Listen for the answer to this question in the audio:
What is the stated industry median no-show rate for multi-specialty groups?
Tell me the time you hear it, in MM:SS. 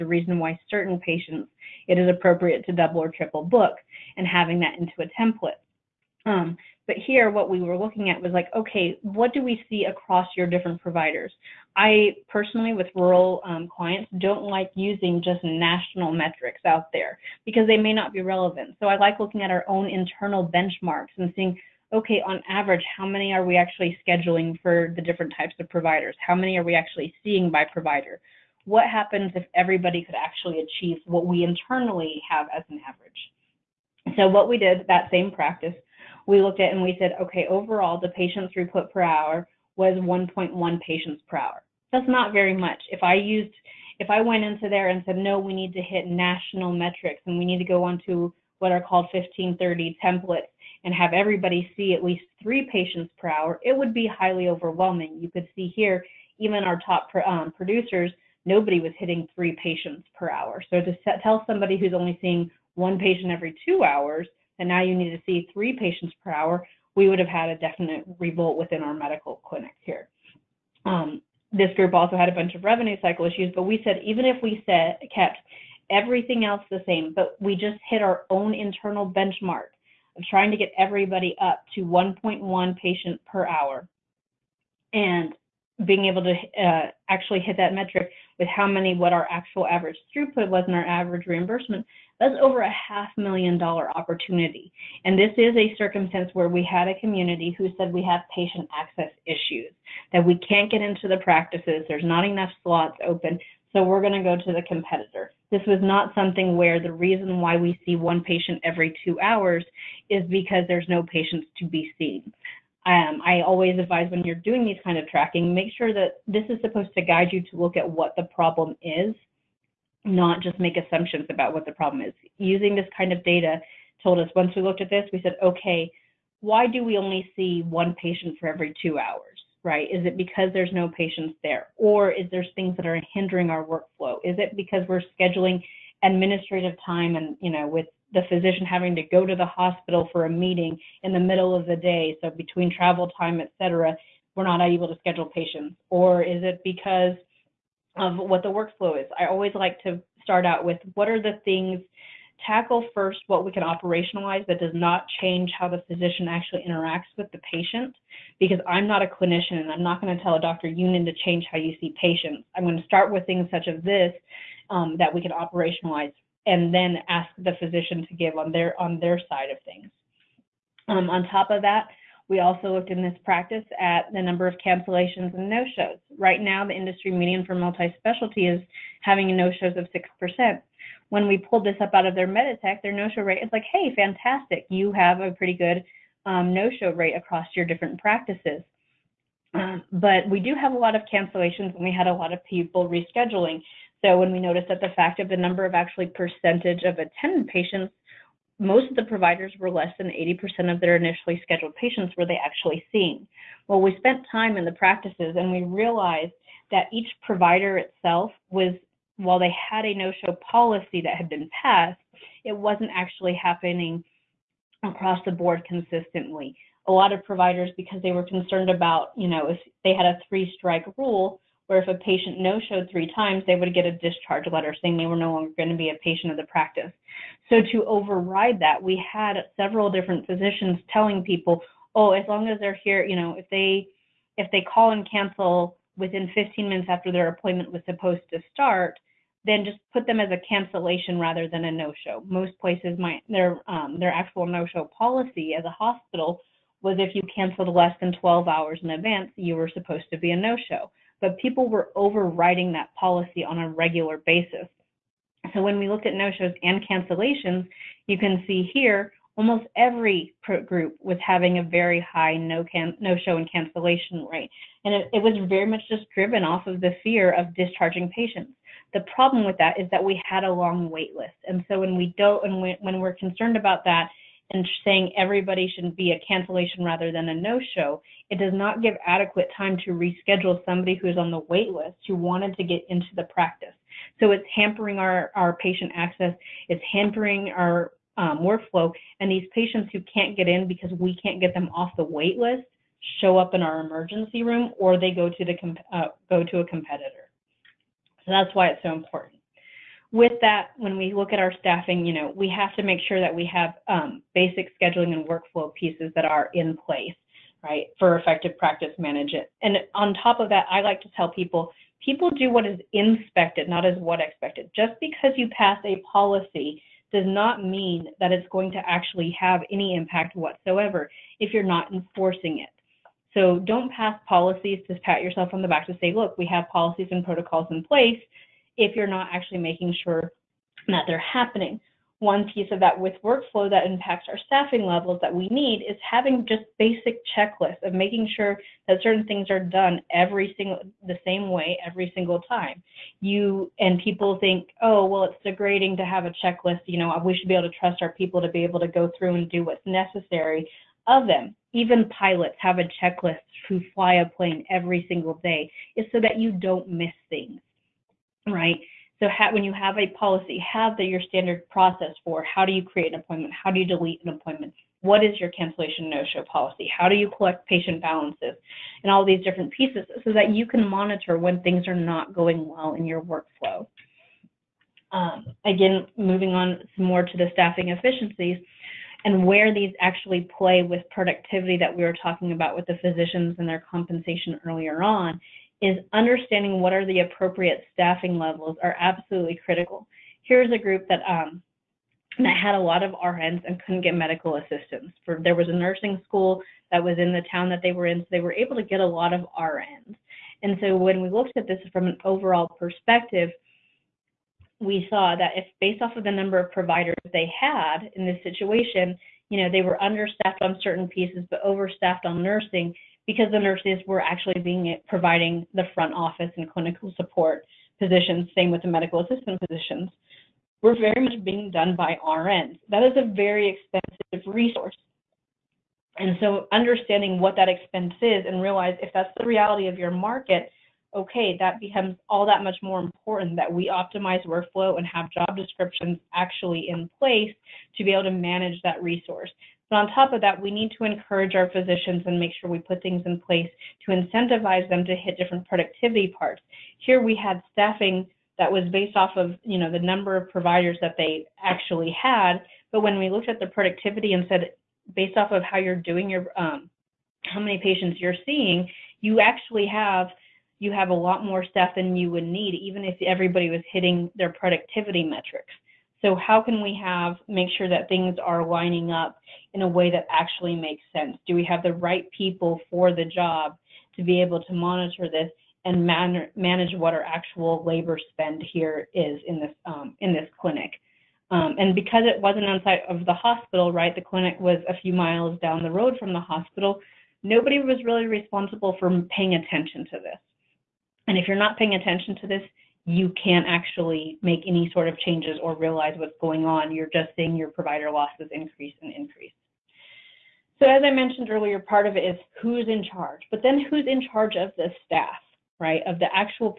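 03:00.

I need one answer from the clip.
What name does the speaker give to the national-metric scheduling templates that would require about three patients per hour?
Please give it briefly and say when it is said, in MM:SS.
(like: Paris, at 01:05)
1530 templates, at 00:49.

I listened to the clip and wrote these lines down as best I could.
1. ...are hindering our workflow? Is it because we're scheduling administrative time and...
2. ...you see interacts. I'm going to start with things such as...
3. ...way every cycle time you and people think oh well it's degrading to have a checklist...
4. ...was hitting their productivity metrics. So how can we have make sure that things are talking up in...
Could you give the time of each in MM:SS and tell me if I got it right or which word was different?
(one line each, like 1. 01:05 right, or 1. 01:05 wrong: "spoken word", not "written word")
1. 02:12 right
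2. 02:41 wrong: "patients", not "interacts"
3. 05:41 wrong: "single", not "cycle"
4. 07:43 wrong: "lining", not "talking".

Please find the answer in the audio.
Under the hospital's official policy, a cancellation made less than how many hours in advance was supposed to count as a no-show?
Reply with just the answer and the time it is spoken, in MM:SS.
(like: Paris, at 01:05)
12 hours, at 04:08.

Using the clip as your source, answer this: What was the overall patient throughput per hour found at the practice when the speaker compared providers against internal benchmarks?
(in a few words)
1.1.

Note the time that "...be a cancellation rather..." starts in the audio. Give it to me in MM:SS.
04:35.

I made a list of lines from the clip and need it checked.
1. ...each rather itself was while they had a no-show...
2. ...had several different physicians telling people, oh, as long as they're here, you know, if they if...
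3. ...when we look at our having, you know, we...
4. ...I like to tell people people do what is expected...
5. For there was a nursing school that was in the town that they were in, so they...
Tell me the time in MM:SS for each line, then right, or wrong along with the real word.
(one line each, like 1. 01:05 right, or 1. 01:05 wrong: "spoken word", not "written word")
1. 03:26 wrong: "provider", not "rather"
2. 03:49 right
3. 05:00 wrong: "staffing", not "having"
4. 05:10 wrong: "inspected", not "expected"
5. 06:35 right.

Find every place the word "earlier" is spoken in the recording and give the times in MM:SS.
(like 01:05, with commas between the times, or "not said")
06:24, 08:21.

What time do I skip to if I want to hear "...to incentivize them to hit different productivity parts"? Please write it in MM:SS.
07:24.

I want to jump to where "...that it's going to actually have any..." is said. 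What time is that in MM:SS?
05:18.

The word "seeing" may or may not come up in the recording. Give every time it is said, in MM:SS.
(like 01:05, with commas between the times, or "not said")
00:21, 00:27, 01:02, 03:22, 07:38, 08:17.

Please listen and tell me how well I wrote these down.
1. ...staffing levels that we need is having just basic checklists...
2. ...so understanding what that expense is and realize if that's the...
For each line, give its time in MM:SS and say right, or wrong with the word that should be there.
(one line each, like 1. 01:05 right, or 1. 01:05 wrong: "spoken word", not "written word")
1. 05:34 right
2. 07:06 right.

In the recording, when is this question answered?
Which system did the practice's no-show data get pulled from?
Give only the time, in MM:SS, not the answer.
03:02.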